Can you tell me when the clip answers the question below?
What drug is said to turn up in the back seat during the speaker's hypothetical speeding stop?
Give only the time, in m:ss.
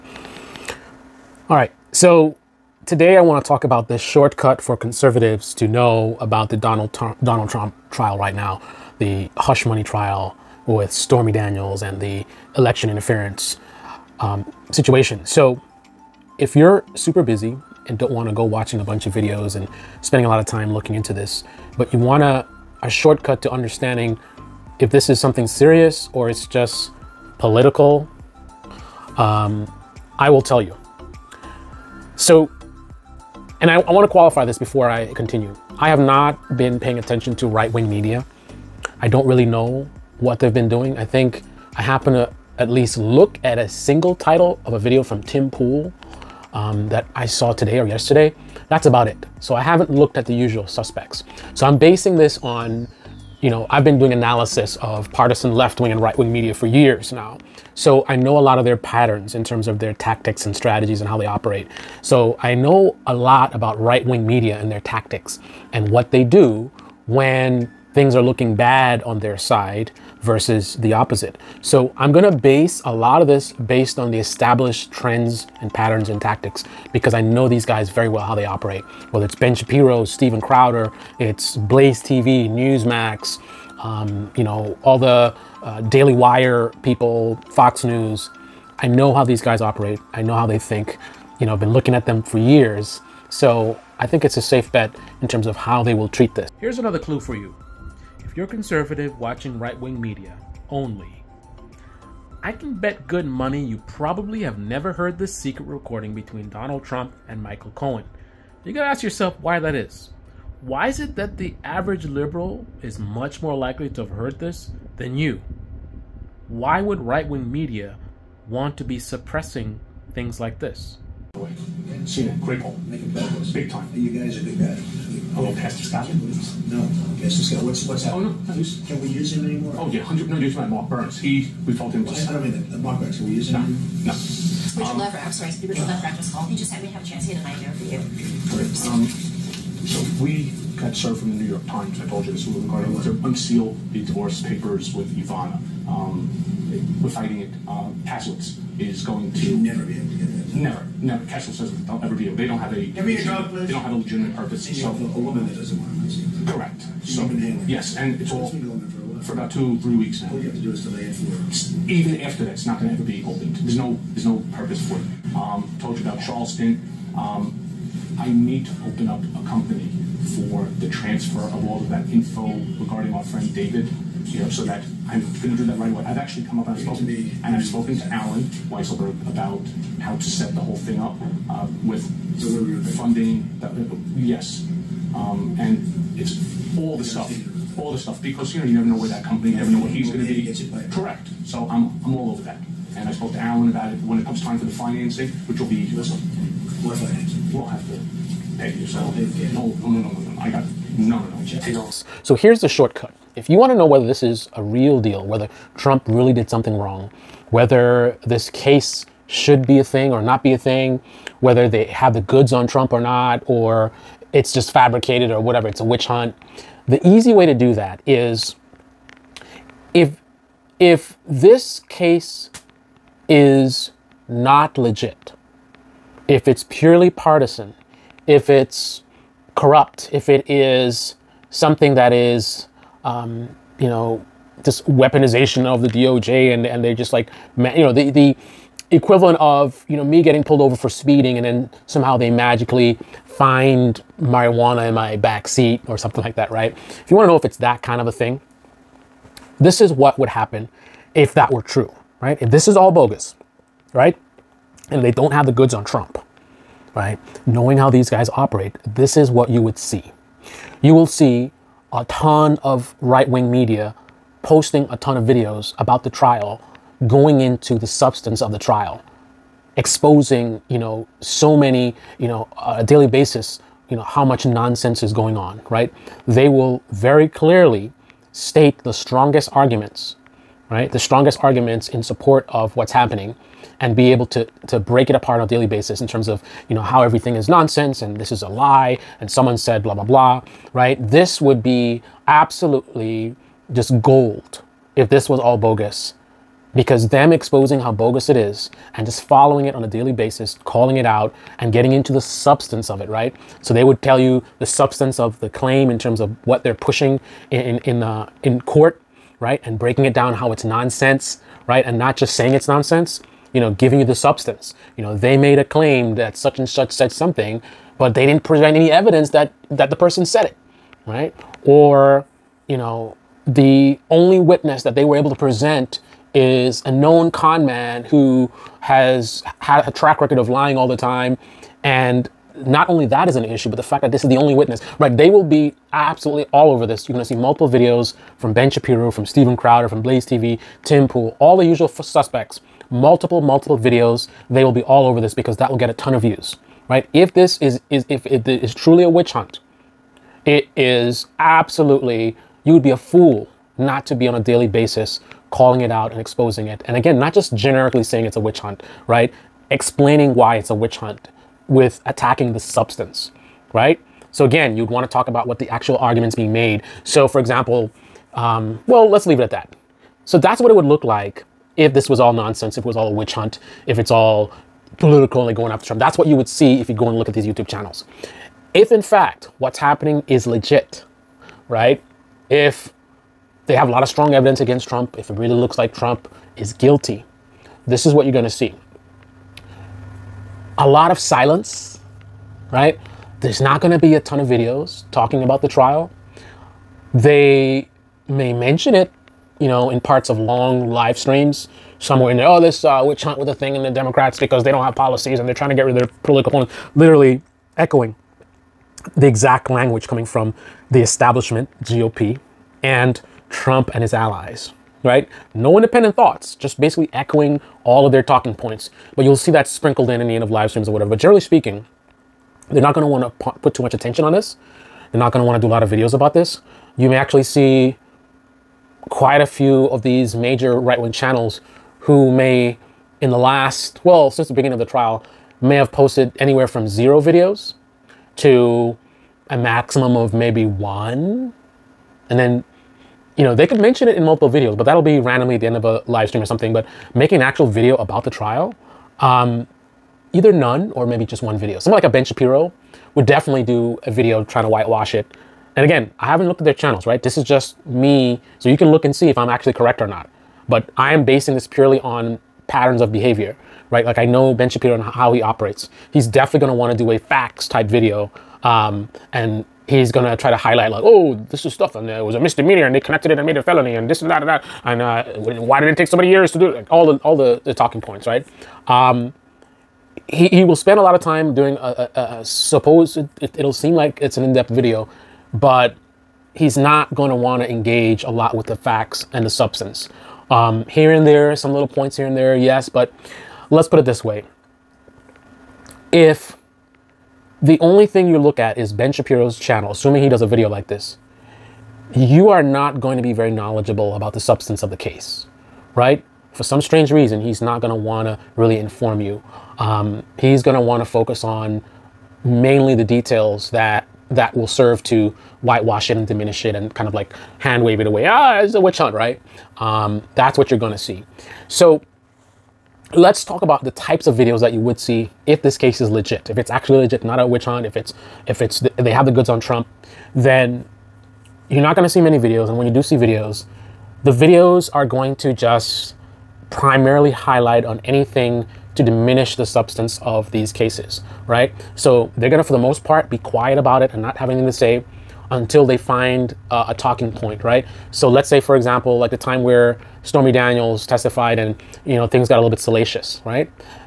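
4:04.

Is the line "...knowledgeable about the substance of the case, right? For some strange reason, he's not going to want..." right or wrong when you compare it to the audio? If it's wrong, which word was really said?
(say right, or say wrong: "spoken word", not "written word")
right.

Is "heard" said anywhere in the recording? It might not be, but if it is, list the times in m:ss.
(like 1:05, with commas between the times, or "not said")
1:44, 1:54.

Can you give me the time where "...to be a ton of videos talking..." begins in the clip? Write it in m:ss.
6:33.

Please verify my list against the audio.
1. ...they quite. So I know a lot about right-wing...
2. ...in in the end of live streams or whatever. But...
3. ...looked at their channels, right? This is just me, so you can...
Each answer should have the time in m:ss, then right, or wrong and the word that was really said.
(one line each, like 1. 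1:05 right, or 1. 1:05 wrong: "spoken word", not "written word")
1. 1:01 wrong: "operate", not "quite"
2. 7:00 right
3. 7:36 right.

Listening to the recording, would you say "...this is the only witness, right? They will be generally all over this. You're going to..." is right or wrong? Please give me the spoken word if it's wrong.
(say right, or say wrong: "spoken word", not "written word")
wrong: "absolutely", not "generally".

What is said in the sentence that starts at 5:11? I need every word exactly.
And not just saying it's nonsense, you know, giving you the substance.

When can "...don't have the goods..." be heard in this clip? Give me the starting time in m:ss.
4:15.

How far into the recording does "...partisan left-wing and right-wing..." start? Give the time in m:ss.
0:55.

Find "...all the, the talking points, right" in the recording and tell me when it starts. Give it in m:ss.
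7:57.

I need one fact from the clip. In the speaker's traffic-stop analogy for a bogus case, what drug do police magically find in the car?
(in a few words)
marijuana.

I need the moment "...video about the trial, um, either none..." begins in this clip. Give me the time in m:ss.
7:27.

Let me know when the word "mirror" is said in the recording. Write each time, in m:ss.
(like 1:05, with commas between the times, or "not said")
not said.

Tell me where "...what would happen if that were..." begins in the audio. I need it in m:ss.
4:09.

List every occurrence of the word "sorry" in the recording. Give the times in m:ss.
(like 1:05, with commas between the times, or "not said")
2:15.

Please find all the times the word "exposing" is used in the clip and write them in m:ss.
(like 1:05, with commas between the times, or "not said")
4:29, 4:57, 5:56.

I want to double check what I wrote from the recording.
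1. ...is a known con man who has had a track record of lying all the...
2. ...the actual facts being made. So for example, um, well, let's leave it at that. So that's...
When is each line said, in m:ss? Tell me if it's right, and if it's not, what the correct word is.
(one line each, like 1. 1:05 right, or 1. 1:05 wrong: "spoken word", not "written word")
1. 5:26 right
2. 6:05 wrong: "arguments", not "facts".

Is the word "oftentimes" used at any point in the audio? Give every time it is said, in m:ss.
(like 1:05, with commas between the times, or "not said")
not said.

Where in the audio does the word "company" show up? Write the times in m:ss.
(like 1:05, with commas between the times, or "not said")
2:49, 3:09.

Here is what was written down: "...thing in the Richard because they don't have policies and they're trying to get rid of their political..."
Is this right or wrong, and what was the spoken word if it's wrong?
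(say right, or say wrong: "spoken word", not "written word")
wrong: "Democrats", not "Richard".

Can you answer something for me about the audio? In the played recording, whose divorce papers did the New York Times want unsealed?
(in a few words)
Ivana.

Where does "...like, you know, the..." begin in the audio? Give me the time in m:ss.
3:57.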